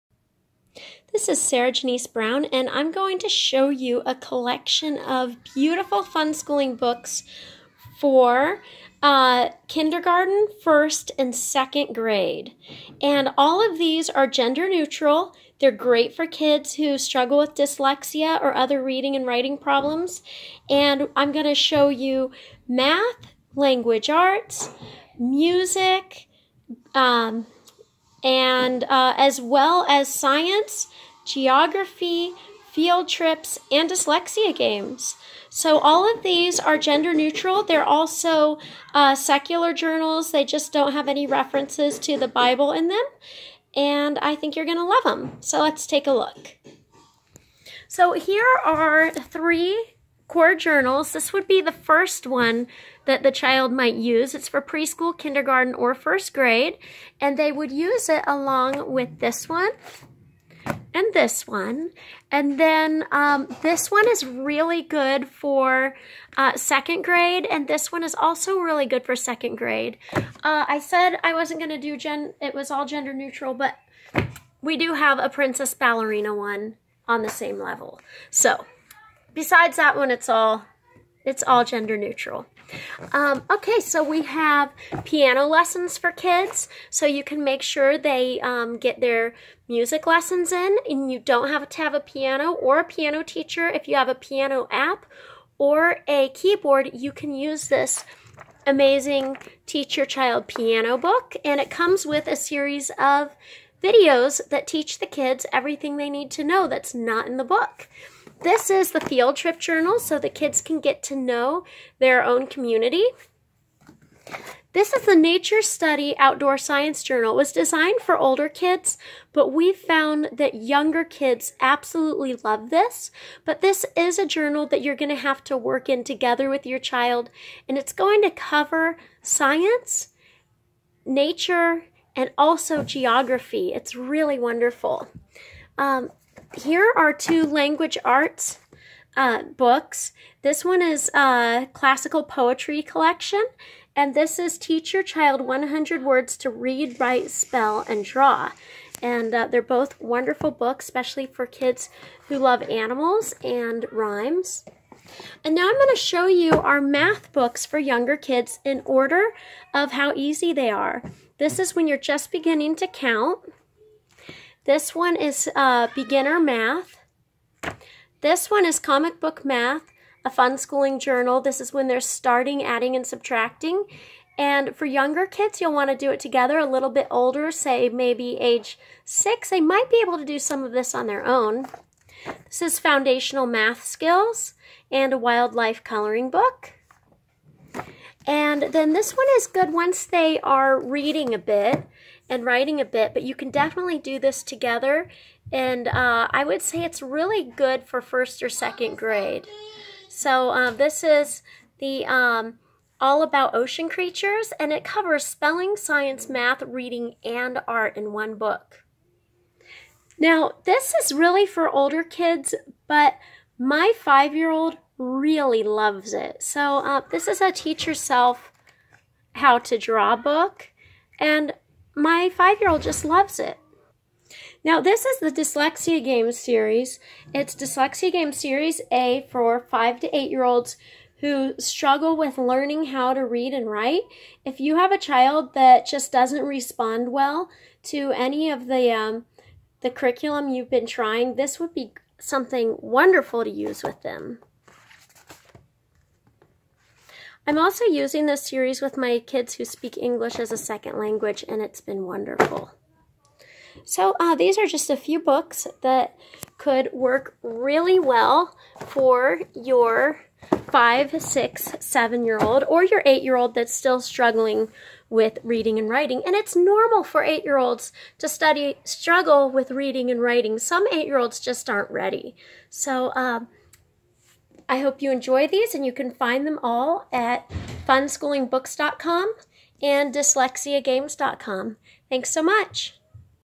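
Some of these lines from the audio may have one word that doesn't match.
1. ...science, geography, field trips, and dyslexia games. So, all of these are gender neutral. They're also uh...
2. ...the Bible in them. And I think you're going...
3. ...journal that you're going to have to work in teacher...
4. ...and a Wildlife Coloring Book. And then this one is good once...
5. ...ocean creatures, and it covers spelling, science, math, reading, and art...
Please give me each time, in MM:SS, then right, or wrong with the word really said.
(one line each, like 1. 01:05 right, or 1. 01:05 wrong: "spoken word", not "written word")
1. 00:30 right
2. 00:42 right
3. 02:04 wrong: "together", not "teacher"
4. 03:04 right
5. 03:23 right.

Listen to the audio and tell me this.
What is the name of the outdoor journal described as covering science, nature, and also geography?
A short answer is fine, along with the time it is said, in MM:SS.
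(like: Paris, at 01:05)
Nature Study Outdoor Science Journal, at 01:55.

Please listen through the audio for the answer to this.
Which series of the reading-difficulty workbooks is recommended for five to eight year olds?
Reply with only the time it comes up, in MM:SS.
03:48.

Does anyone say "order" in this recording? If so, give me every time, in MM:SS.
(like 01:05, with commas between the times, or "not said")
02:38.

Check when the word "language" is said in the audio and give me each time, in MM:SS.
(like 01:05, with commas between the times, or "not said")
00:23, 02:17, 04:10.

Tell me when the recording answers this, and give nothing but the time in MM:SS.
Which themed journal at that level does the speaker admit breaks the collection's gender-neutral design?
01:15.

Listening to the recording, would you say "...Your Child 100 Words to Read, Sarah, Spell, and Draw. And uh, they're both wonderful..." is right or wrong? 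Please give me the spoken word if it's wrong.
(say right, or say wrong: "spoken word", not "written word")
wrong: "Write", not "Sarah".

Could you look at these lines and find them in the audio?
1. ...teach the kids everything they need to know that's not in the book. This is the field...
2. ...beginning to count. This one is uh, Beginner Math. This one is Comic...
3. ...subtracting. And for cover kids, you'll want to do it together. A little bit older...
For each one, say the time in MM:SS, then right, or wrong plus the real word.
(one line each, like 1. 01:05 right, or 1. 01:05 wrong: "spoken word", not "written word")
1. 01:44 right
2. 02:42 right
3. 02:53 wrong: "younger", not "cover".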